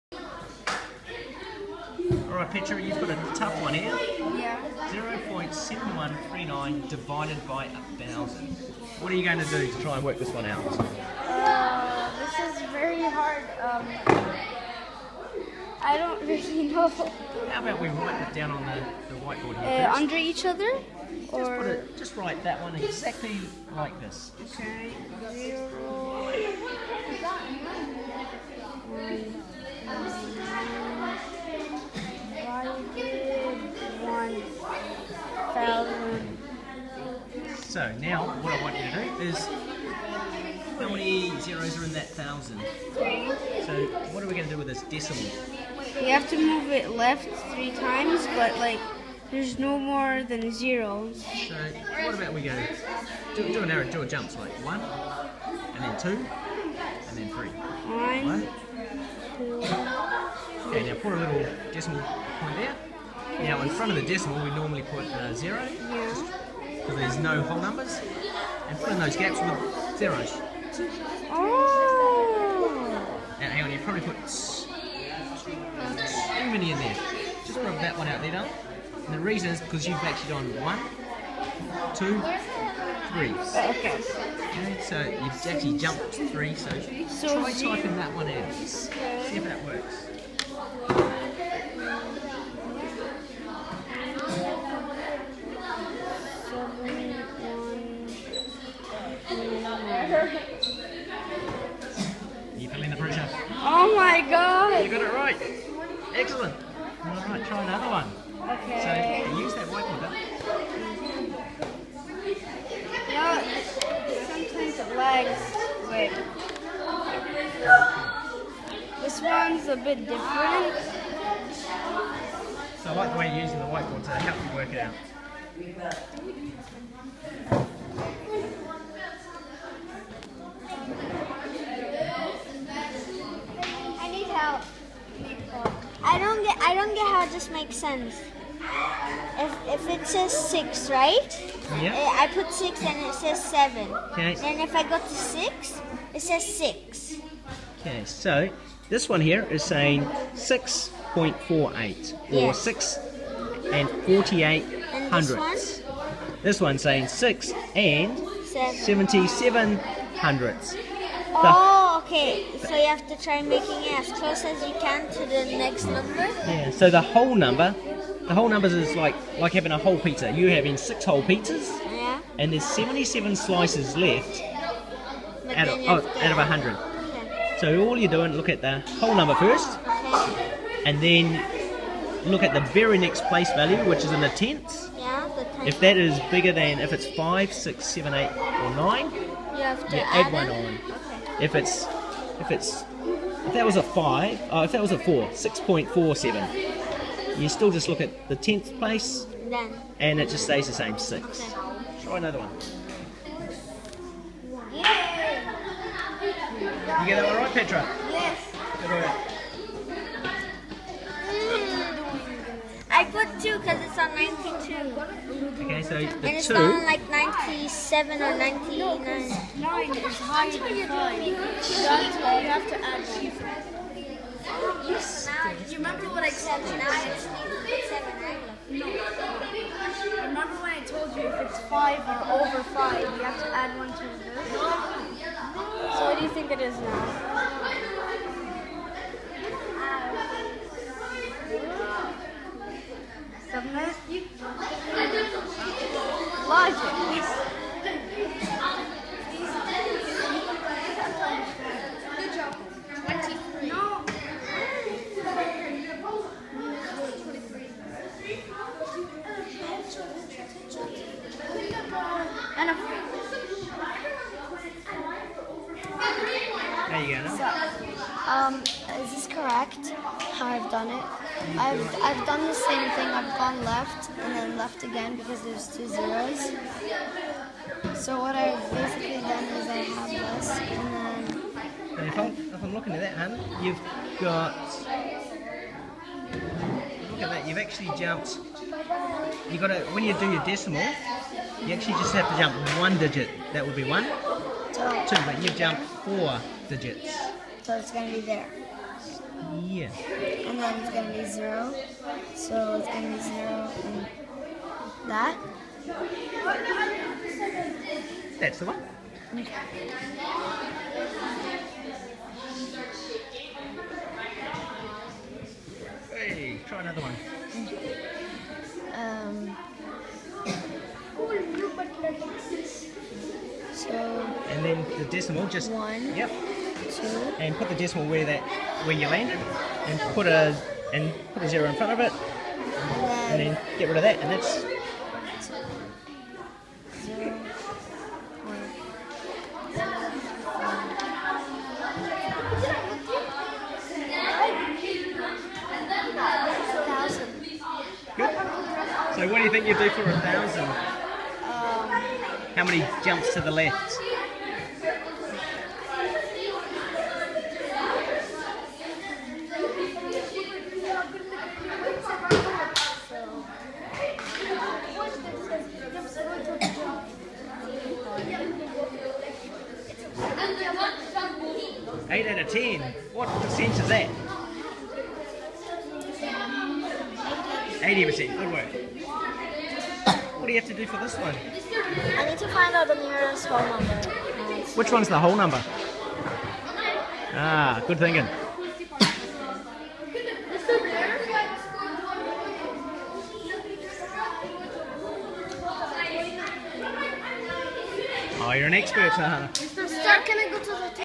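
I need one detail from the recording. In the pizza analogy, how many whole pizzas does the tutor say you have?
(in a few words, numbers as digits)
6.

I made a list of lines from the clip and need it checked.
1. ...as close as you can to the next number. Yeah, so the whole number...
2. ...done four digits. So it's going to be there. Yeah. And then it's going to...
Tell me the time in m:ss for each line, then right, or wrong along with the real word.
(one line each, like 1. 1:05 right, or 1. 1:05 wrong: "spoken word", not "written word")
1. 2:43 right
2. 4:55 right.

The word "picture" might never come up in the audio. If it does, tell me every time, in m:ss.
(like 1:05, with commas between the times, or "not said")
0:02.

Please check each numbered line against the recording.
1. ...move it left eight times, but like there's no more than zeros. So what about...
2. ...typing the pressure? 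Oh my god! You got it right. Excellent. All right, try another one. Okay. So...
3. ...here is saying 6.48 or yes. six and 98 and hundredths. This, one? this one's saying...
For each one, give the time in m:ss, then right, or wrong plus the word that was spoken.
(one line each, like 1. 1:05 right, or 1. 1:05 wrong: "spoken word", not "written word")
1. 0:46 wrong: "three", not "eight"
2. 1:42 wrong: "feeling", not "typing"
3. 2:29 wrong: "48", not "98".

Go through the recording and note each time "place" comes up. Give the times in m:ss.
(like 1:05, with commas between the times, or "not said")
3:03, 3:18.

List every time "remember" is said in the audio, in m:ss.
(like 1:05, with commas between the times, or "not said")
3:45, 3:50.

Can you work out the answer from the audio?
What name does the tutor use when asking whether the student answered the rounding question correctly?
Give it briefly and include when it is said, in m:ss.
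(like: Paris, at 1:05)
Petra, at 3:27.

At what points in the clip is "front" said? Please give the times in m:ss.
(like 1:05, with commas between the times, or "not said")
1:03, 5:31.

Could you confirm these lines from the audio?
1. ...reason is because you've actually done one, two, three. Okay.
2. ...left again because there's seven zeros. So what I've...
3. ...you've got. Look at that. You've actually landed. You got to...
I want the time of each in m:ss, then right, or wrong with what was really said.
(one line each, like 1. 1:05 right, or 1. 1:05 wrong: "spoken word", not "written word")
1. 1:19 right
2. 4:34 wrong: "two", not "seven"
3. 4:43 wrong: "jumped", not "landed".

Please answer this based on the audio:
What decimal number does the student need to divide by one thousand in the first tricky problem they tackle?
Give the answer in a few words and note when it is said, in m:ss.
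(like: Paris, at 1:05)
0.7139, at 0:05.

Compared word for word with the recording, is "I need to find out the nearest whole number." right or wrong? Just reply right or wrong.
right.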